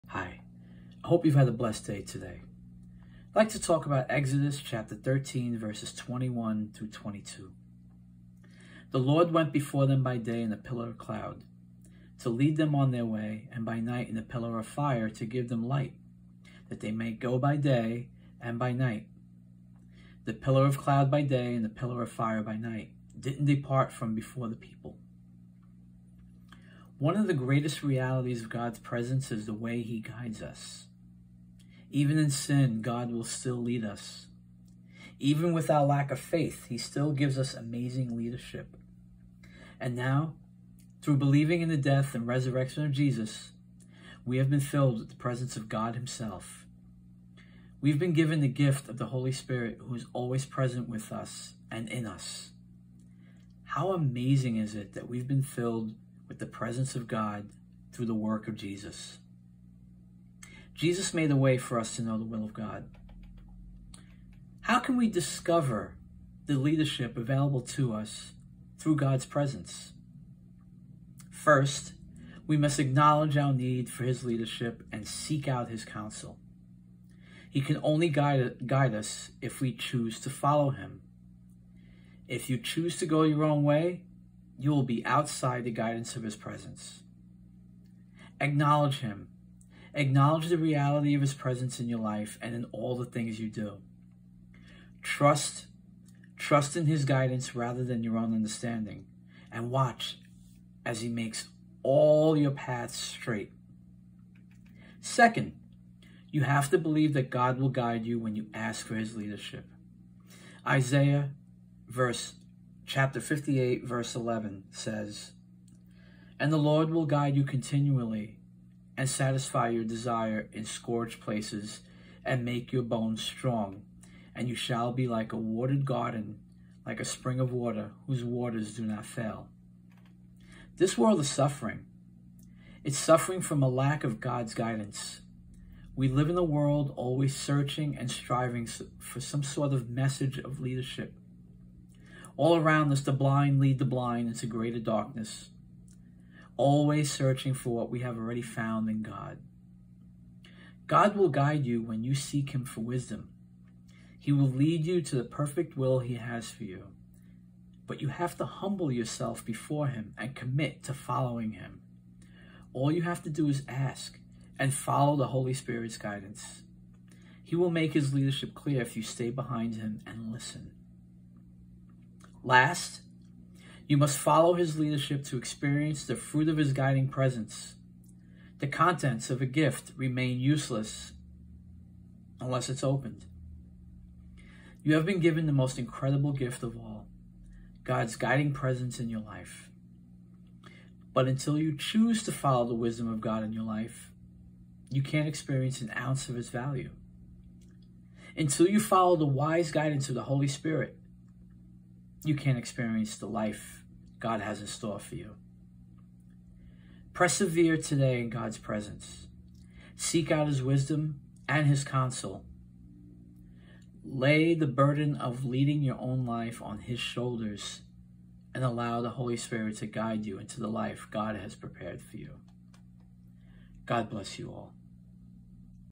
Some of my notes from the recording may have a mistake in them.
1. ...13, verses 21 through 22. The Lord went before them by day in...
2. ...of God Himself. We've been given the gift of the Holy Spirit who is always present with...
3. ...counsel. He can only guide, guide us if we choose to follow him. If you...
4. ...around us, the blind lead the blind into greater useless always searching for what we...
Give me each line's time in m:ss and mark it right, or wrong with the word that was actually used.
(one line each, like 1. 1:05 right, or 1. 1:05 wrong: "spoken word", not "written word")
1. 0:04 right
2. 0:45 right
3. 1:15 right
4. 2:22 wrong: "darkness", not "useless".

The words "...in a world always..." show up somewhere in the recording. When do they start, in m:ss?
2:16.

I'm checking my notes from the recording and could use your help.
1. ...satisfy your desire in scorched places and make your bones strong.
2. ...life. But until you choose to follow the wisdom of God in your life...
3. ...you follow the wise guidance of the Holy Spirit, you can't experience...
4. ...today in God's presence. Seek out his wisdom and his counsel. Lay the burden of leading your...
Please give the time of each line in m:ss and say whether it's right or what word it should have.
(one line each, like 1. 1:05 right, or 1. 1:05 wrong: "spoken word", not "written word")
1. 1:59 right
2. 3:09 right
3. 3:18 right
4. 3:27 right.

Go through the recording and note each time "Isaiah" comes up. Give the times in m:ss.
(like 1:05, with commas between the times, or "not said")
1:50.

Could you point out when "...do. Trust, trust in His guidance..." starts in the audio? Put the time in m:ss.
1:33.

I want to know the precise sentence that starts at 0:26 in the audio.
One of the greatest realities of God's presence is the way He guides us.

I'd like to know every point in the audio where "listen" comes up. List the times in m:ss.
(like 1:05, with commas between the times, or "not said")
2:50.